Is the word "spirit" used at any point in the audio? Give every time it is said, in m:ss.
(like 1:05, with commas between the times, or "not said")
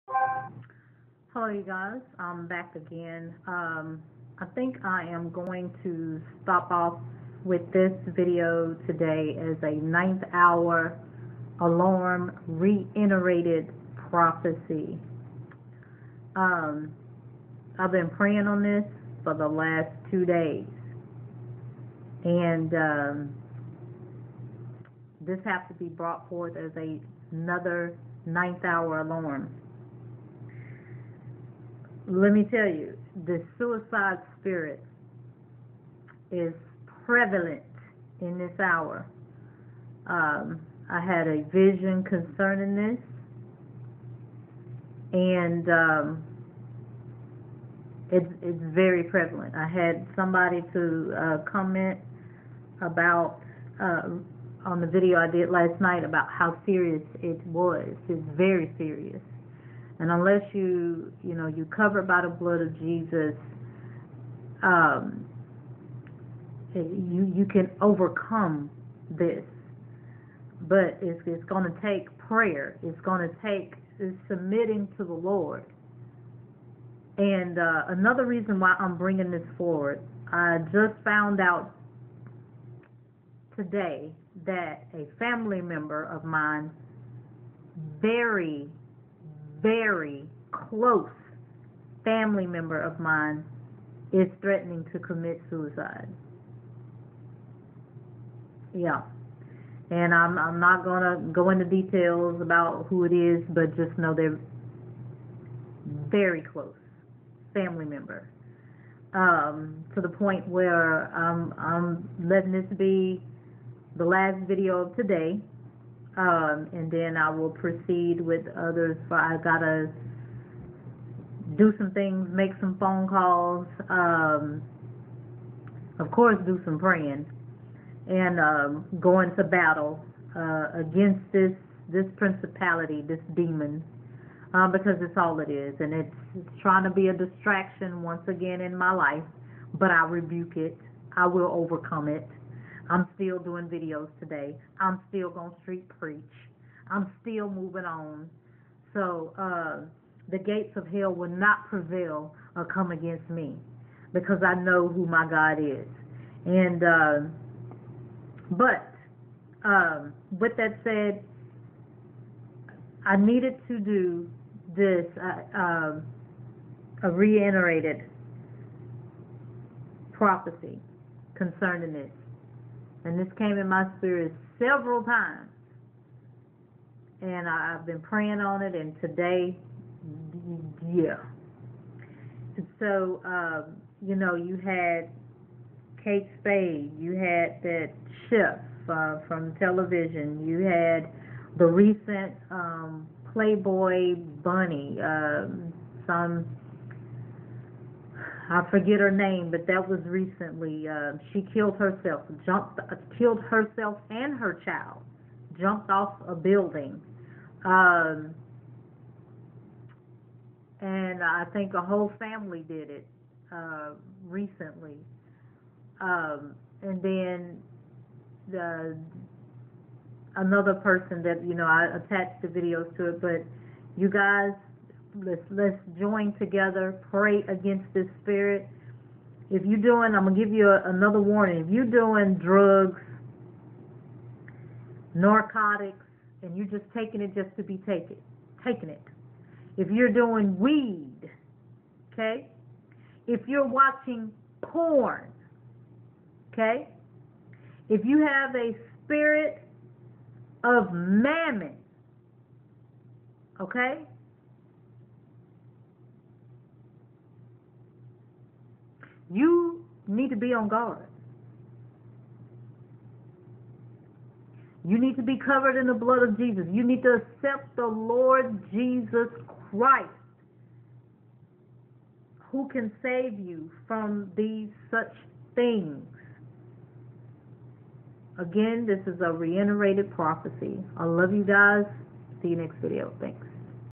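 0:34, 2:53, 3:48, 4:09.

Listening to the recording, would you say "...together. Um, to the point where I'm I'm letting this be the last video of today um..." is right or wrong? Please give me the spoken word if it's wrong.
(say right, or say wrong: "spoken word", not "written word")
wrong: "member", not "together".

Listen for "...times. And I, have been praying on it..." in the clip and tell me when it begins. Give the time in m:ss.
2:55.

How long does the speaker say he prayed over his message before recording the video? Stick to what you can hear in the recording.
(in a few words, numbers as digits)
2 days.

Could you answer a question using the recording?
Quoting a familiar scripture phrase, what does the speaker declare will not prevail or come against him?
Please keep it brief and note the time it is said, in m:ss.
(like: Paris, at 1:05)
the gates of hell, at 2:30.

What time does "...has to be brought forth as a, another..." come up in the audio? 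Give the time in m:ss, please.
0:25.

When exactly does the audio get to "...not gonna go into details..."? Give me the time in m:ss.
1:40.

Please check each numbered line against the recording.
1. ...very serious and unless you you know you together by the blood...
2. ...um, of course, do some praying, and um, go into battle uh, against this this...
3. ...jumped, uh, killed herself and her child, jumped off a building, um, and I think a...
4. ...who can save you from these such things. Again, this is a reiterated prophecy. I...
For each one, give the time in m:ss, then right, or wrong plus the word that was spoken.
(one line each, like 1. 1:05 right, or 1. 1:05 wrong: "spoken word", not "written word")
1. 0:58 wrong: "cover", not "together"
2. 2:03 right
3. 3:22 right
4. 4:32 right.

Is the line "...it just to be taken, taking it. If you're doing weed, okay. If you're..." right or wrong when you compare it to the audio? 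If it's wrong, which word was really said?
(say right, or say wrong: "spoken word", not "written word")
right.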